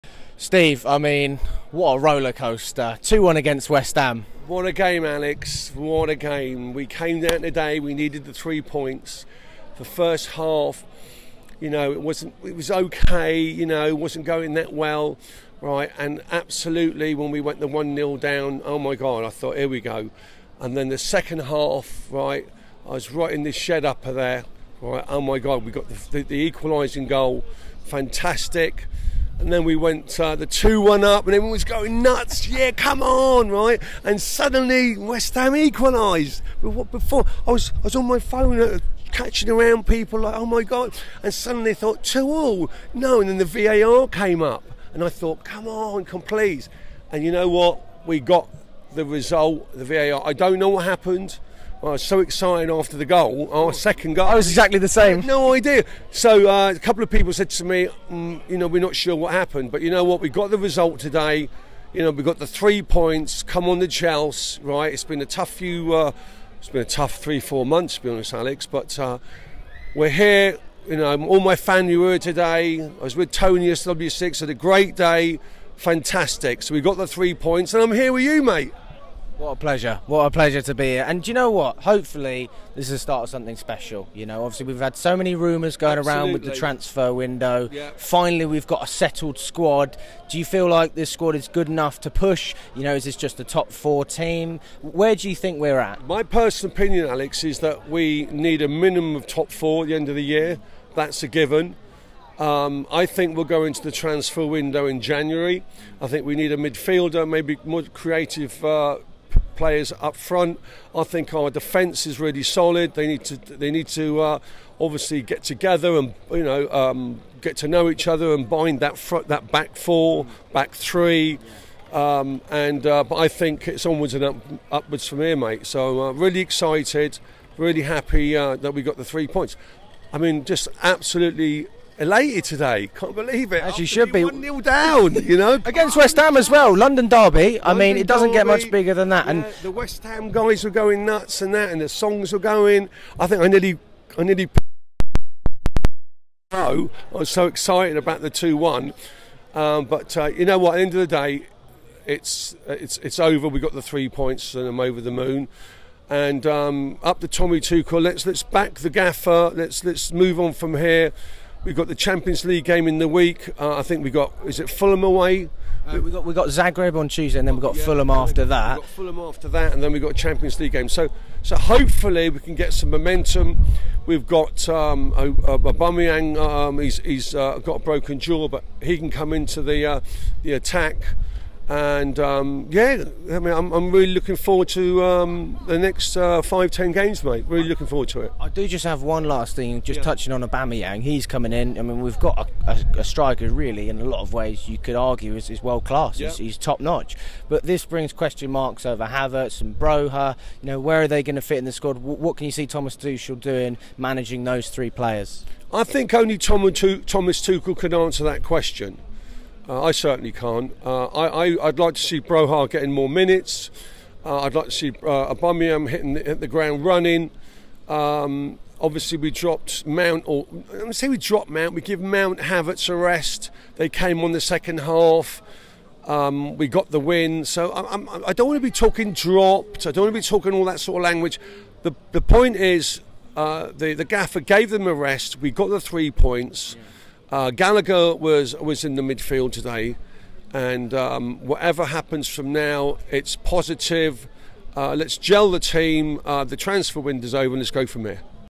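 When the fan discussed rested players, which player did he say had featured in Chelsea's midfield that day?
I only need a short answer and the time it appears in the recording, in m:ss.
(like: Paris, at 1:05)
Gallagher, at 3:57.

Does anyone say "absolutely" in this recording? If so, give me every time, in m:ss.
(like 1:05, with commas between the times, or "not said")
0:16, 1:25, 2:10.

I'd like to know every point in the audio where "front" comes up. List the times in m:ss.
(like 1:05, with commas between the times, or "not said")
1:50, 1:58.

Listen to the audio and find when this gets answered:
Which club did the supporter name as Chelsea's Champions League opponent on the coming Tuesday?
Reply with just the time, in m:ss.
2:46.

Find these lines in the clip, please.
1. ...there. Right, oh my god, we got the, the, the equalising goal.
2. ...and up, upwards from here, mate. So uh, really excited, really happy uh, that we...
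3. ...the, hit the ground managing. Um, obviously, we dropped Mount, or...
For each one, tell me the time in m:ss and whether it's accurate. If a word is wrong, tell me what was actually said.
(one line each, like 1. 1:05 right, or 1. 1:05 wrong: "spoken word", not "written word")
1. 0:24 right
2. 2:04 right
3. 3:36 wrong: "running", not "managing".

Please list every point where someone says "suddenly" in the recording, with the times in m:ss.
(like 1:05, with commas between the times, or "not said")
0:34, 0:41.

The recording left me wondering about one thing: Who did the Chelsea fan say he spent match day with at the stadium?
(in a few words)
Tony.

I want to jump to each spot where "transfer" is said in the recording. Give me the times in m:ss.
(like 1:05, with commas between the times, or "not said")
1:26, 1:43, 4:06.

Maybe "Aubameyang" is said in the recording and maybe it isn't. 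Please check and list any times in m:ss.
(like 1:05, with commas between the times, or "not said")
2:55, 3:10, 3:35.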